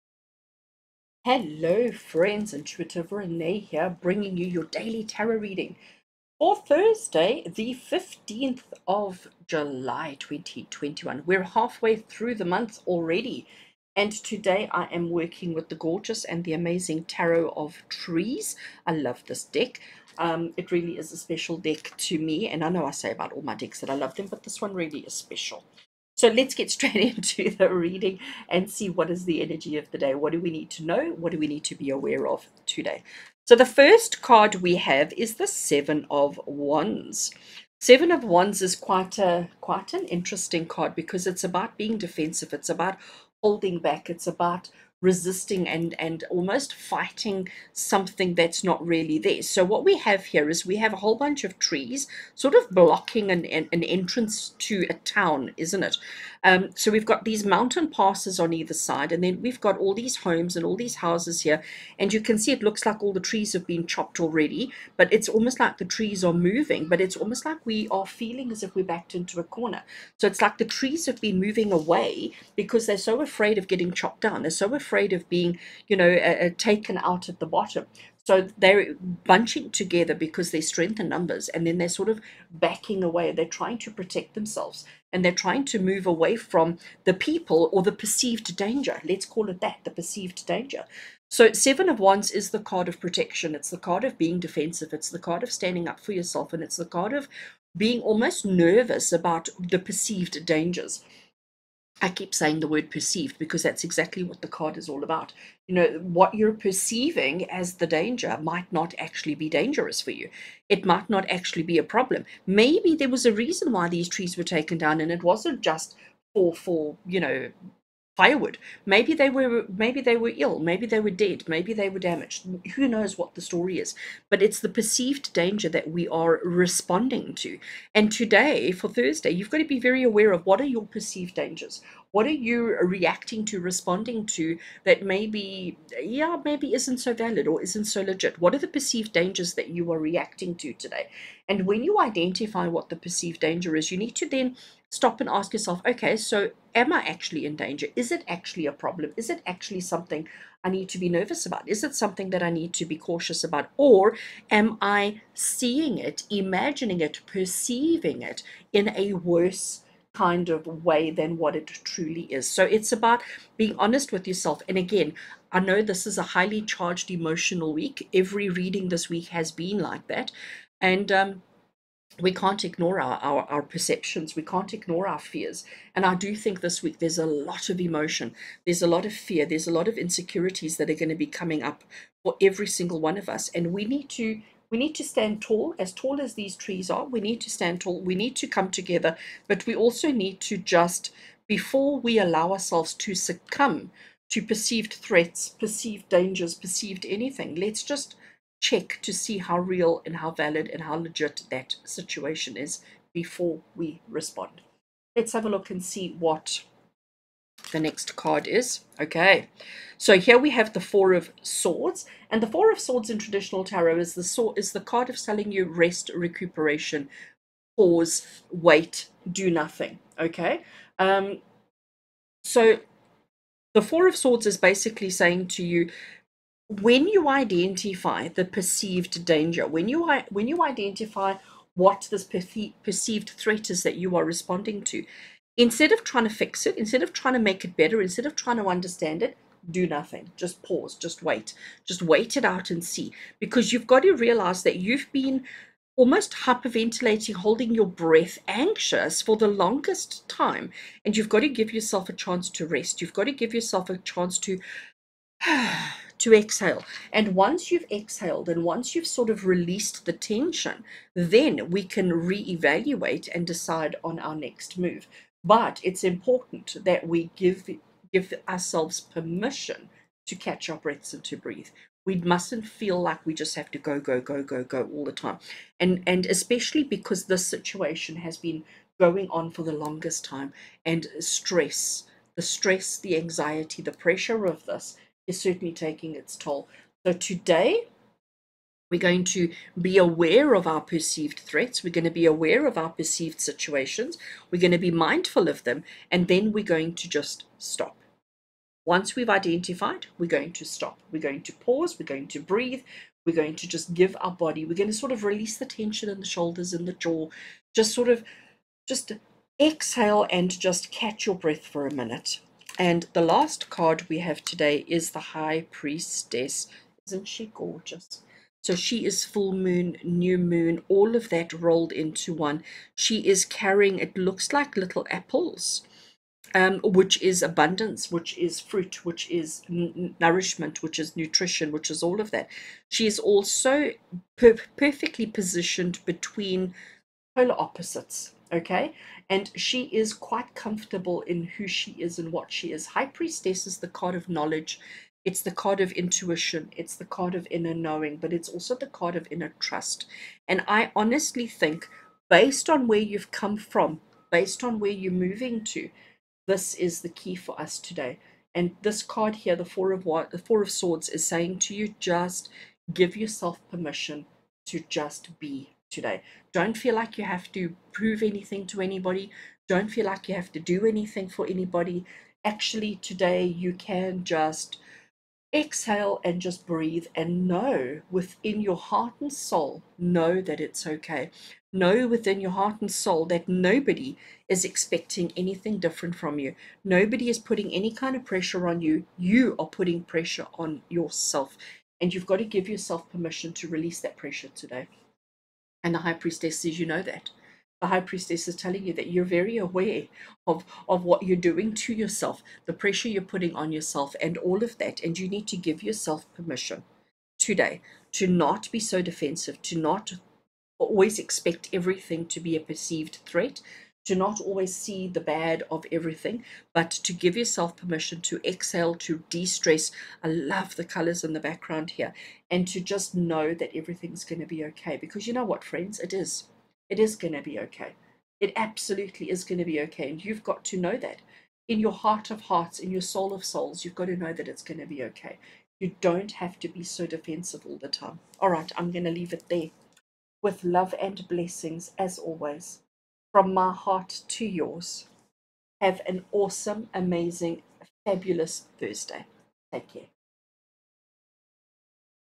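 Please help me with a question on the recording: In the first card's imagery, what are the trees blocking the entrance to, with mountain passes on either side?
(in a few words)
a town.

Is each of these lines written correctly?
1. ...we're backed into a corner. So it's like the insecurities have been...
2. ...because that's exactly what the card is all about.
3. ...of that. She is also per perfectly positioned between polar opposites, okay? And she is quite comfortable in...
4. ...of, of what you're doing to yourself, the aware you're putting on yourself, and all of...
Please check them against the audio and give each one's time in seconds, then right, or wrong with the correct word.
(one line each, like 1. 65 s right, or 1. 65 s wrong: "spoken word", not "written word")
1. 68 s wrong: "trees", not "insecurities"
2. 103 s right
3. 332 s right
4. 400 s wrong: "pressure", not "aware".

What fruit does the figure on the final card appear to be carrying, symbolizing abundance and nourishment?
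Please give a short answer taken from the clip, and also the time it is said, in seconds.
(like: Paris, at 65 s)
apples, at 325 s.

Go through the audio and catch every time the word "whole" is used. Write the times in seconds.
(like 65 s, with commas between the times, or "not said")
50 s.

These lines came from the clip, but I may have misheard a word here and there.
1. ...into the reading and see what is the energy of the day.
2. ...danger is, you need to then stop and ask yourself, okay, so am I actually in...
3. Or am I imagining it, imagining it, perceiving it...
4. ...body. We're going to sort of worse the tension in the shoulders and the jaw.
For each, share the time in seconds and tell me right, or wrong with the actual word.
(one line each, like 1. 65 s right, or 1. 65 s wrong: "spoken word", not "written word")
1. 27 s right
2. 143 s right
3. 153 s wrong: "seeing", not "imagining"
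4. 304 s wrong: "release", not "worse".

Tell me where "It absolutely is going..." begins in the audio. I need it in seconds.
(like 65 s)
428 s.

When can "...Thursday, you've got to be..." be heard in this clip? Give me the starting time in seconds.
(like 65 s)
128 s.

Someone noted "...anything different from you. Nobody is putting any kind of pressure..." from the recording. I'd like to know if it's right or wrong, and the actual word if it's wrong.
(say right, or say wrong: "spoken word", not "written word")
right.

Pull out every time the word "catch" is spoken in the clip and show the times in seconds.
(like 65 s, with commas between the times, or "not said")
270 s, 310 s.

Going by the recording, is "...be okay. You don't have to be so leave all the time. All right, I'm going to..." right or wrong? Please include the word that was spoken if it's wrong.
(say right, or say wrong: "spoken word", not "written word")
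wrong: "defensive", not "leave".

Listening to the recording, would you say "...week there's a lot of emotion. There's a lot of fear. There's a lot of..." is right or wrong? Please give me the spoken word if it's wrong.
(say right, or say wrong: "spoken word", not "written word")
right.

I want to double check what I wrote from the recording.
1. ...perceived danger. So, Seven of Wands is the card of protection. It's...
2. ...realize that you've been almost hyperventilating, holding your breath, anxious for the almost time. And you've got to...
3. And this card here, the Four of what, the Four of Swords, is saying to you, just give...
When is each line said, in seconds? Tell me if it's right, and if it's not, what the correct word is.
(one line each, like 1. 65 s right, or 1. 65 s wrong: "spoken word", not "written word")
1. 89 s right
2. 244 s wrong: "longest", not "almost"
3. 358 s right.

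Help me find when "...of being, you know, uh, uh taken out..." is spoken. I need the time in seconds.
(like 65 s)
75 s.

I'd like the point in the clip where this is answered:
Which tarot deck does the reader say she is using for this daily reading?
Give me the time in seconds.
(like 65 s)
17 s.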